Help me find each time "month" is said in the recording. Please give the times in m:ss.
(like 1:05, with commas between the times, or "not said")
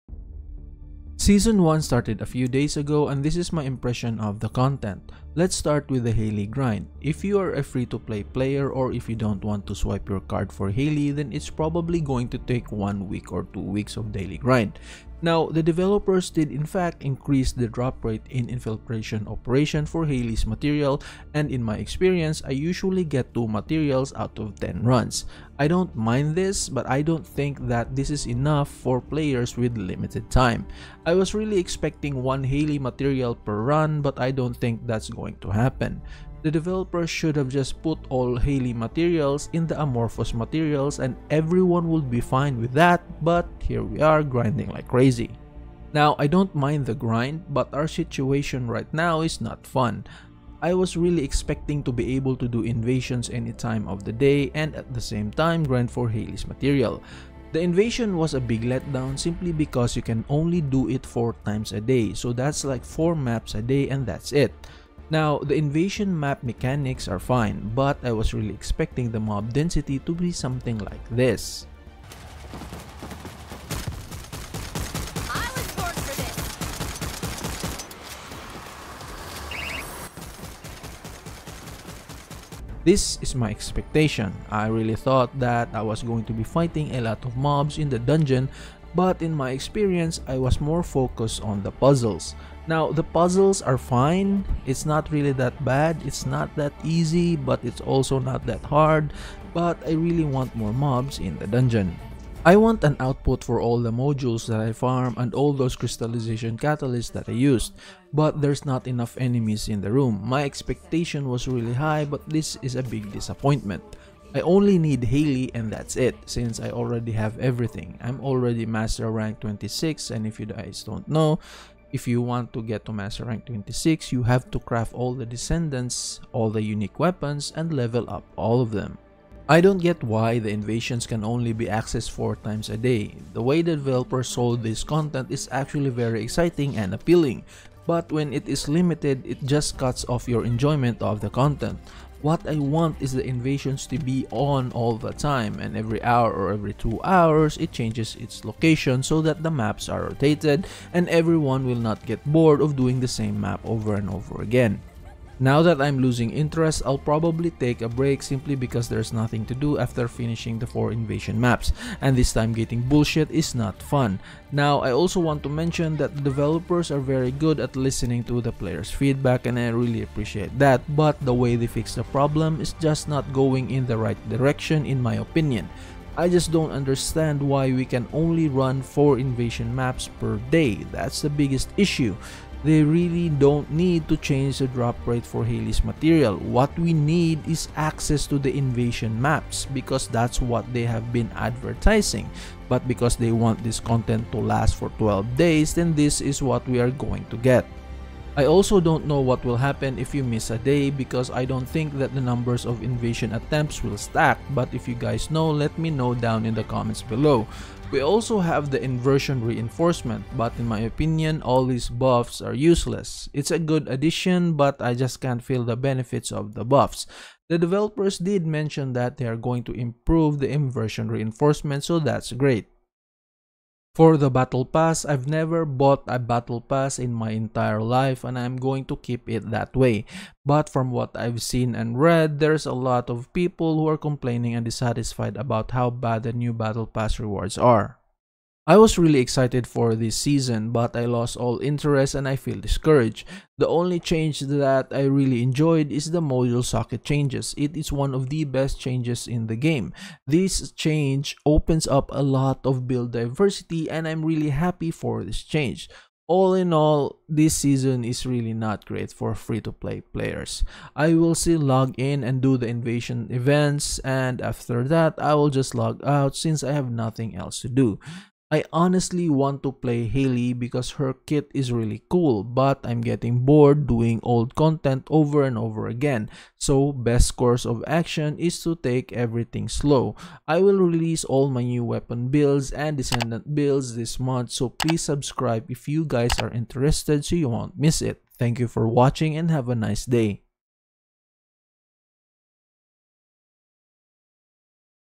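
4:44.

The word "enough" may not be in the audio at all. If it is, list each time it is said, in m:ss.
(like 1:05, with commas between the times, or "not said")
0:28, 1:48.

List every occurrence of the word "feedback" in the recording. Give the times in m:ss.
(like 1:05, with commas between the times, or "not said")
2:48.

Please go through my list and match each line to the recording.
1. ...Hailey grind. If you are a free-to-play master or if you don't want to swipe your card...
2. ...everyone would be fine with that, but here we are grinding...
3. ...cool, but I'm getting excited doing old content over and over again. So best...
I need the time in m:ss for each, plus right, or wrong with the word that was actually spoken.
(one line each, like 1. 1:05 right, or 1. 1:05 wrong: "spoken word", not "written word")
1. 0:06 wrong: "player", not "master"
2. 0:41 right
3. 4:32 wrong: "bored", not "excited".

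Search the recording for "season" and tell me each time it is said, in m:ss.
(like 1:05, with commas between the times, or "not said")
0:01, 4:00, 4:17.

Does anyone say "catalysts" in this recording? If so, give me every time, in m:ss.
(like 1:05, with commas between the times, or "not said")
1:46.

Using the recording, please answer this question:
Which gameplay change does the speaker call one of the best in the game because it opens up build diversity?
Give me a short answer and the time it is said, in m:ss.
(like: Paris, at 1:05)
Module socket changes, at 4:06.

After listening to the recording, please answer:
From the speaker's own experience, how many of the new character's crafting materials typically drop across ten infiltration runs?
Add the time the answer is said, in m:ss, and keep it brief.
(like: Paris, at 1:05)
2, at 0:23.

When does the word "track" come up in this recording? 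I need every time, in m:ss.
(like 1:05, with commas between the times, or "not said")
not said.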